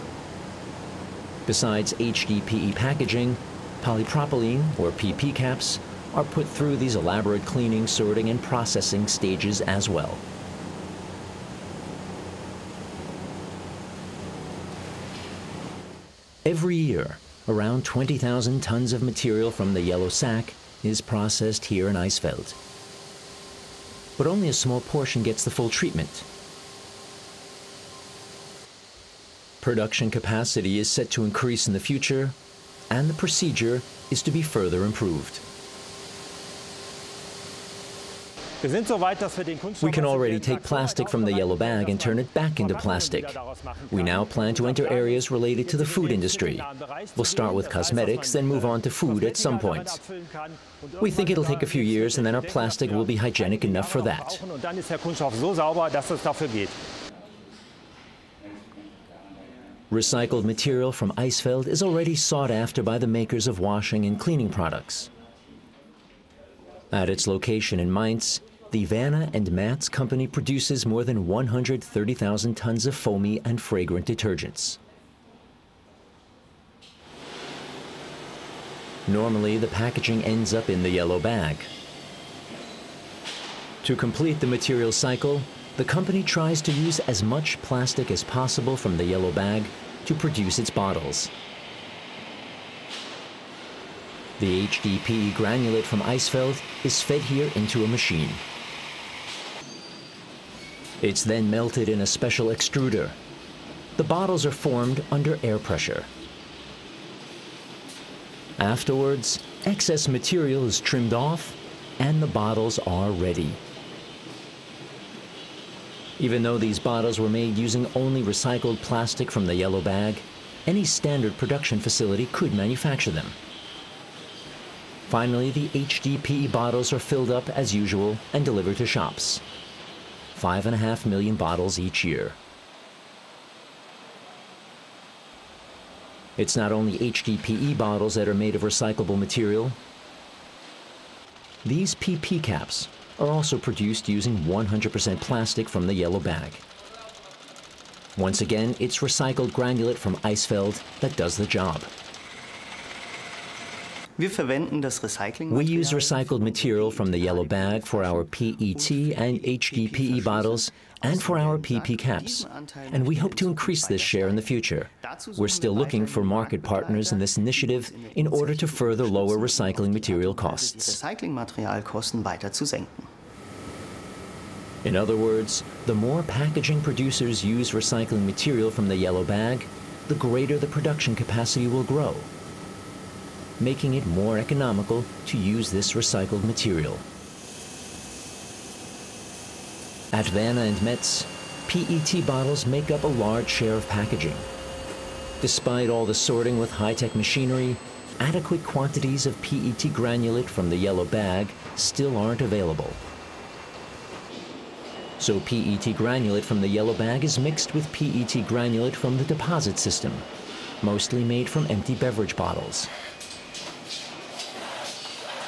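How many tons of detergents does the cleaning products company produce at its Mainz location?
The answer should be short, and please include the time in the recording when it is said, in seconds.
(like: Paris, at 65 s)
more than 130,000 tons, at 70 s.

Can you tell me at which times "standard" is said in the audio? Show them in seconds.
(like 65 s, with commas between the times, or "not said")
120 s.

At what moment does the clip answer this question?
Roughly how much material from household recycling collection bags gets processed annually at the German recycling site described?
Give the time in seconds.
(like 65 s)
17 s.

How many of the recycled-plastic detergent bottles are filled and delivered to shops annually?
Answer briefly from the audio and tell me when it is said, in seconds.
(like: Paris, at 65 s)
5.5 million, at 130 s.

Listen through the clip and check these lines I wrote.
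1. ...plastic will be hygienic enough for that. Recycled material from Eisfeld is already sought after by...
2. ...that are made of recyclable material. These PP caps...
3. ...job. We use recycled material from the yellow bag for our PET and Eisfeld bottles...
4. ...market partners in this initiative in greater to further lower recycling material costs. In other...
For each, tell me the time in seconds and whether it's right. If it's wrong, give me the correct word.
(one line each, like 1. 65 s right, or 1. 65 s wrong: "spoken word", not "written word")
1. 52 s right
2. 138 s right
3. 151 s wrong: "HDPE", not "Eisfeld"
4. 166 s wrong: "order", not "greater".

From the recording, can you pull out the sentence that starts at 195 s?
Despite all the sorting with high-tech machinery, adequate quantities of PET granulate from the yellow bag still aren't available.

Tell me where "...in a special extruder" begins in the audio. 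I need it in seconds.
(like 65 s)
101 s.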